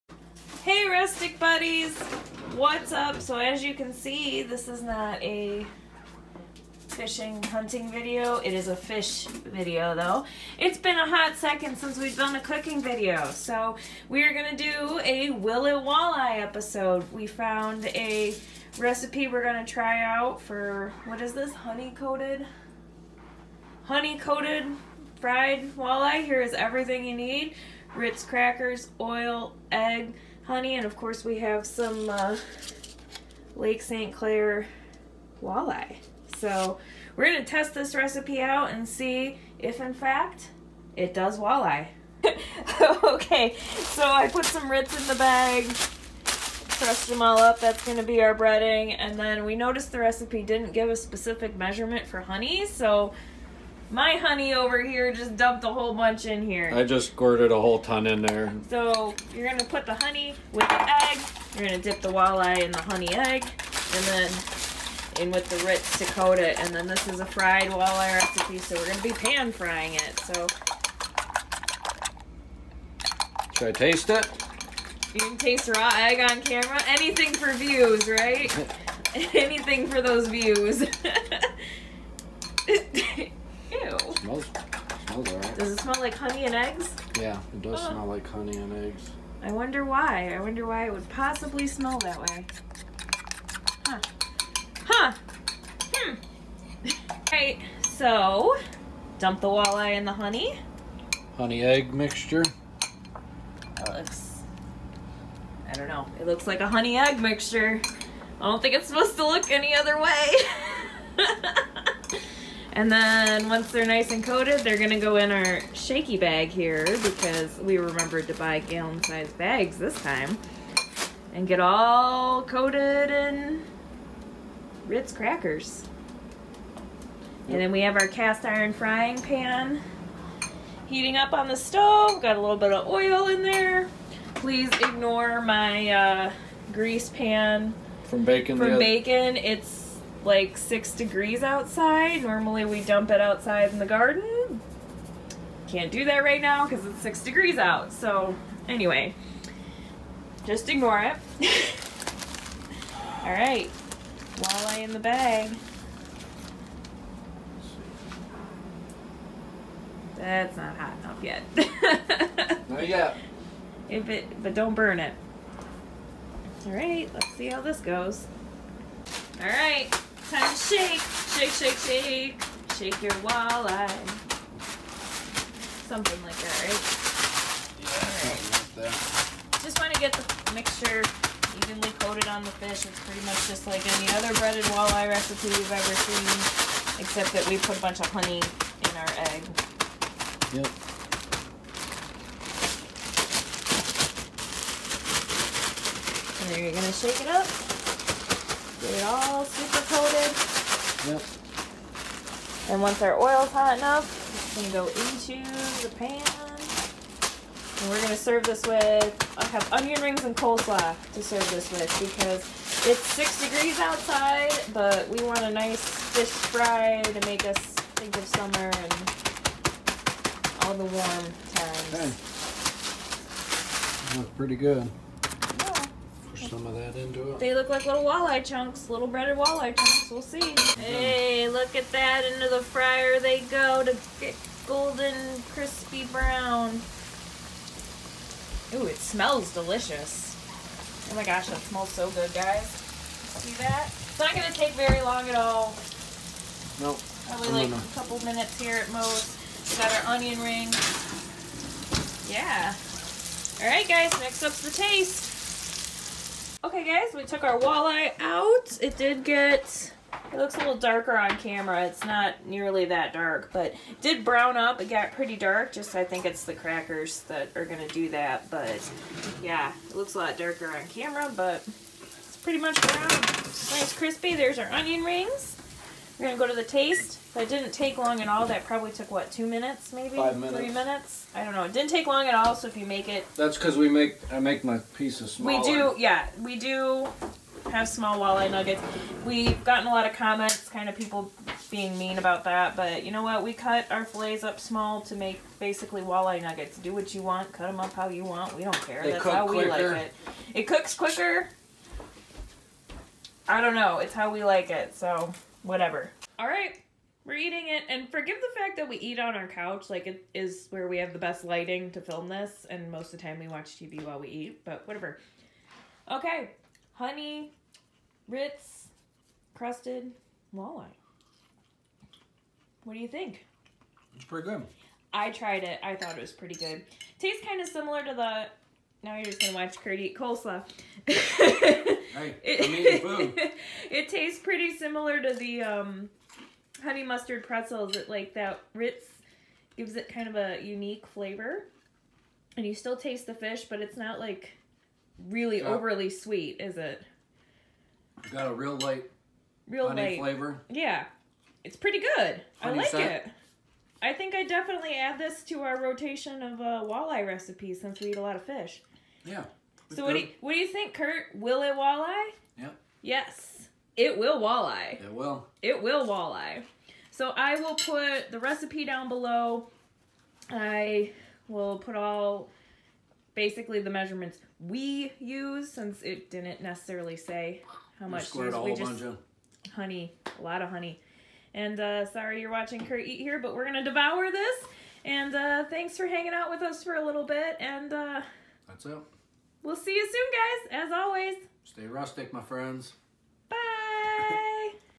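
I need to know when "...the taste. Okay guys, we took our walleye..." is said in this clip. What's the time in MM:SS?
04:14.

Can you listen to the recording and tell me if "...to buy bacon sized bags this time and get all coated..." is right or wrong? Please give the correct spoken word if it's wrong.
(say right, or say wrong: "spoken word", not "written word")
wrong: "gallon", not "bacon".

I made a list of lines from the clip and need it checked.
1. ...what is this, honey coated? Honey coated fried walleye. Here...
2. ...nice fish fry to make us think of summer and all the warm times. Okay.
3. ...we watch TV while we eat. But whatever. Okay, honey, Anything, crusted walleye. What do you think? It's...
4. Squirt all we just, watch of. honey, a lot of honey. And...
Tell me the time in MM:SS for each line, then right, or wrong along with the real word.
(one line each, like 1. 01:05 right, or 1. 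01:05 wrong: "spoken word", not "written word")
1. 00:21 right
2. 03:35 right
3. 05:13 wrong: "Ritz", not "Anything"
4. 06:18 wrong: "bunch", not "watch".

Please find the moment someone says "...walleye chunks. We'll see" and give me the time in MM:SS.
03:49.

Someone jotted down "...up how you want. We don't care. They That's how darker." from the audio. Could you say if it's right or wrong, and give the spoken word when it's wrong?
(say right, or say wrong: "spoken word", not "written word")
wrong: "quicker", not "darker".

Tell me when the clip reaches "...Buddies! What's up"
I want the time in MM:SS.
00:01.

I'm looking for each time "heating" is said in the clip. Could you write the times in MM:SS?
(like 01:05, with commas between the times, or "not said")
02:10.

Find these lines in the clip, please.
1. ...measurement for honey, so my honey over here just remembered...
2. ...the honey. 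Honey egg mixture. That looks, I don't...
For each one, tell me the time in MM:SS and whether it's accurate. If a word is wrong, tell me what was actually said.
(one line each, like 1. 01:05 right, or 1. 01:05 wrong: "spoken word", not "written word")
1. 00:51 wrong: "dumped", not "remembered"
2. 01:40 right.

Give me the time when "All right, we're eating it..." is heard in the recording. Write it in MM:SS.
05:06.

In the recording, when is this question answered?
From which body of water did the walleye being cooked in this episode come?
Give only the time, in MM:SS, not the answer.
00:33.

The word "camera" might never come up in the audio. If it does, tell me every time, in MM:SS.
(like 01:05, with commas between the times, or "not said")
01:16, 04:21, 04:30.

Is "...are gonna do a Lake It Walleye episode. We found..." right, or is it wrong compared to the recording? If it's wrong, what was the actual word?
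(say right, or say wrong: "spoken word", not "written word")
wrong: "Will", not "Lake".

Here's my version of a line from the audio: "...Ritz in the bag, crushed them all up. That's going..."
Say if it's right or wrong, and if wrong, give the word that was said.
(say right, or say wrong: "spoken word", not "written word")
right.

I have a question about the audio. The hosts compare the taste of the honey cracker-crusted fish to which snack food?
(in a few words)
Honey mustard pretzels.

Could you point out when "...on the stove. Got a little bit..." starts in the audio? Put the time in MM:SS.
02:11.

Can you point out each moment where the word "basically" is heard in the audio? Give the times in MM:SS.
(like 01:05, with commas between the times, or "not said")
04:55, 06:13.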